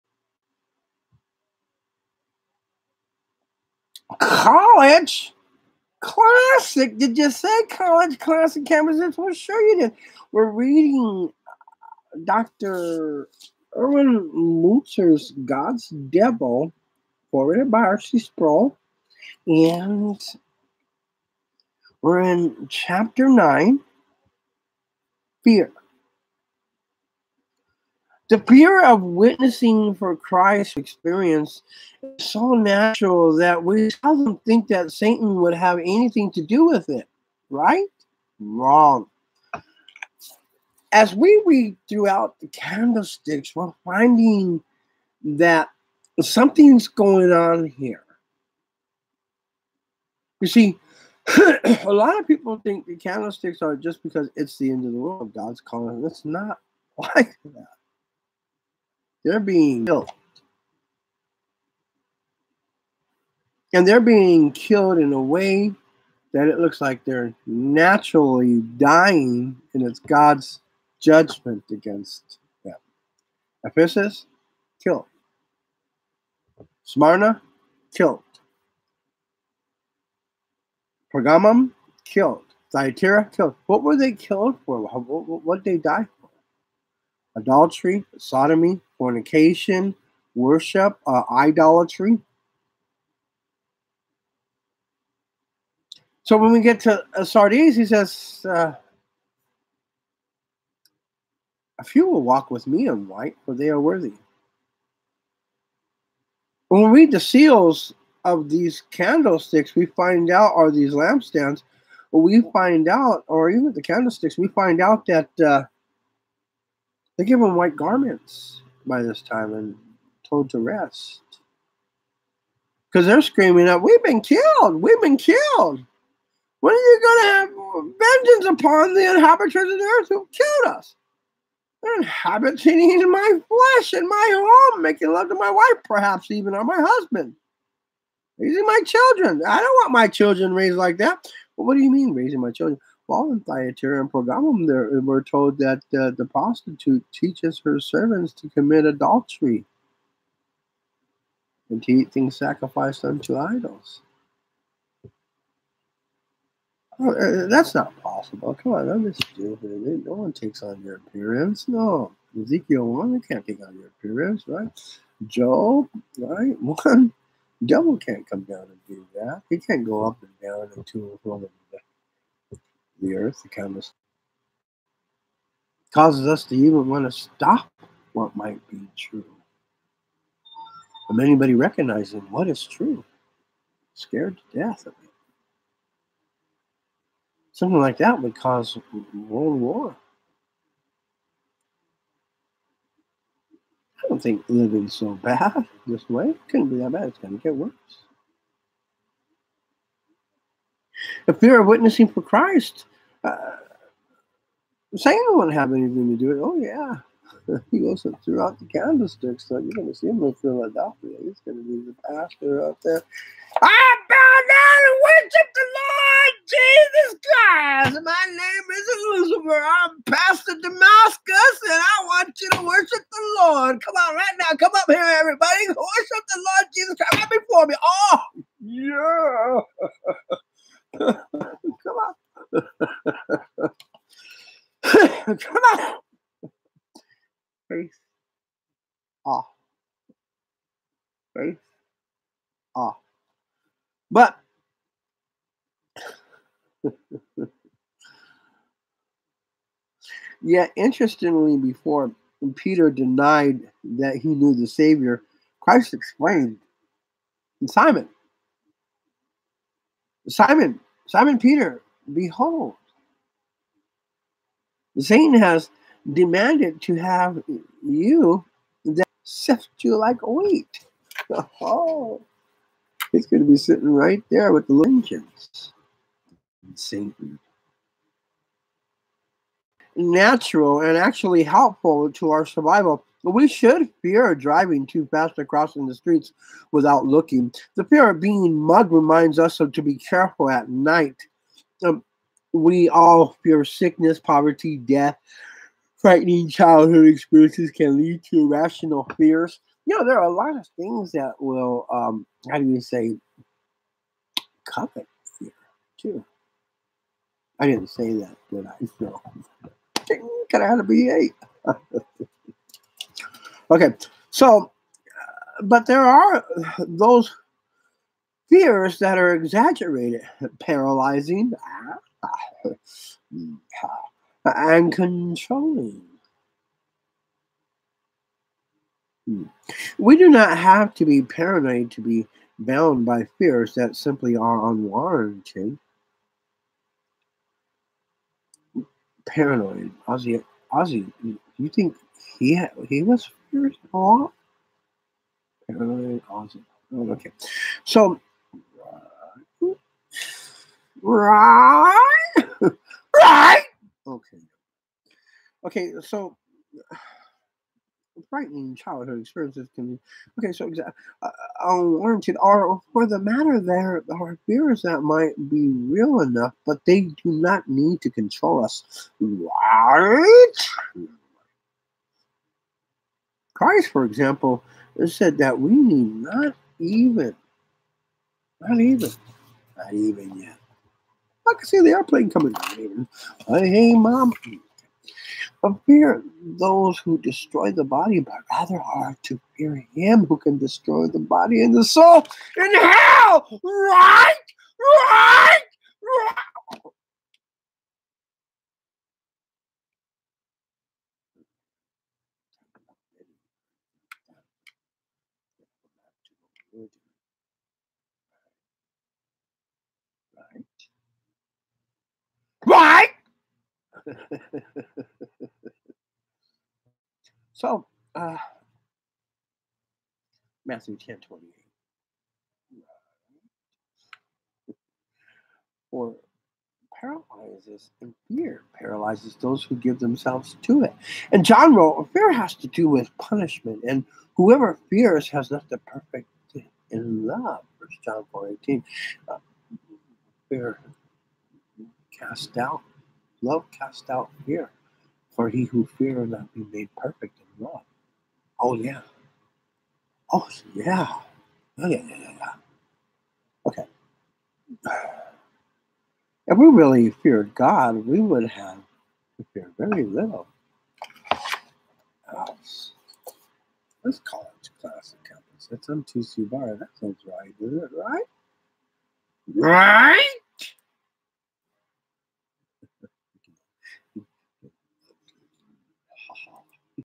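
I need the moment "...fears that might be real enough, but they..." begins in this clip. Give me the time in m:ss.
6:04.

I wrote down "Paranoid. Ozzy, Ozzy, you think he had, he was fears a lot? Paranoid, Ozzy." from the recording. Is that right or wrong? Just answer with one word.
right.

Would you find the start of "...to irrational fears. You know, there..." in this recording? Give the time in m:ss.
4:58.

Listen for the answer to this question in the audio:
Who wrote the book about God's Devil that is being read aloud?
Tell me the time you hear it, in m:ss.
0:13.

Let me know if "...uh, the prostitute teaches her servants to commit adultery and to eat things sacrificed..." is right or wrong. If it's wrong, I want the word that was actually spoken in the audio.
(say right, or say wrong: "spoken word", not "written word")
right.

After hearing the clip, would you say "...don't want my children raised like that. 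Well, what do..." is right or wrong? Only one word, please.
right.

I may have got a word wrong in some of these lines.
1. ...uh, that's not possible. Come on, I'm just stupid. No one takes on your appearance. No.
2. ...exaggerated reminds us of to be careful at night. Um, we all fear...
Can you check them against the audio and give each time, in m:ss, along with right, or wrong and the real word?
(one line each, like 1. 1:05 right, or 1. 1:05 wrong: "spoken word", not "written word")
1. 2:37 right
2. 4:48 wrong: "mugged", not "exaggerated".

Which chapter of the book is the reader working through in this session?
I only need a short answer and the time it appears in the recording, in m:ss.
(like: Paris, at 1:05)
Chapter 9, at 0:22.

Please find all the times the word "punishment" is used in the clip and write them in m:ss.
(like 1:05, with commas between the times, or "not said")
7:13.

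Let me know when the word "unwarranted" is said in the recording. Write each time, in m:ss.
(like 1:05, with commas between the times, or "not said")
5:34, 6:01.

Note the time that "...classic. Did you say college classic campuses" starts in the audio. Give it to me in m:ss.
0:05.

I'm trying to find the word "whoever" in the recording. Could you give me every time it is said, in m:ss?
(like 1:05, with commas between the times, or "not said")
7:14.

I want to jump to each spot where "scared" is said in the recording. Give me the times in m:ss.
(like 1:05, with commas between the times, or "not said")
3:03.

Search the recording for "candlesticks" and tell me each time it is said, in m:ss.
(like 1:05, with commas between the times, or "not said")
0:42, 0:52, 1:48, 1:53, 3:28.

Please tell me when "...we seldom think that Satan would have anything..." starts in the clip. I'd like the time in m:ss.
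0:33.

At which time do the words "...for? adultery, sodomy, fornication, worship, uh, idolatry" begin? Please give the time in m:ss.
1:26.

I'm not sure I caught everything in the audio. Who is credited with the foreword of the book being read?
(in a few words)
Archie Sproul.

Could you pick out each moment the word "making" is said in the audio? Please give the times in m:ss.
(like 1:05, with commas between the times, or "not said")
2:14.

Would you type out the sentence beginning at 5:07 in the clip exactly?
I didn't say that, did I?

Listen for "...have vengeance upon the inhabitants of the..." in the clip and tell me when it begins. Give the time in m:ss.
2:07.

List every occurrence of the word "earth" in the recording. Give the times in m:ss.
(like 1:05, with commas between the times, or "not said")
2:09, 2:53.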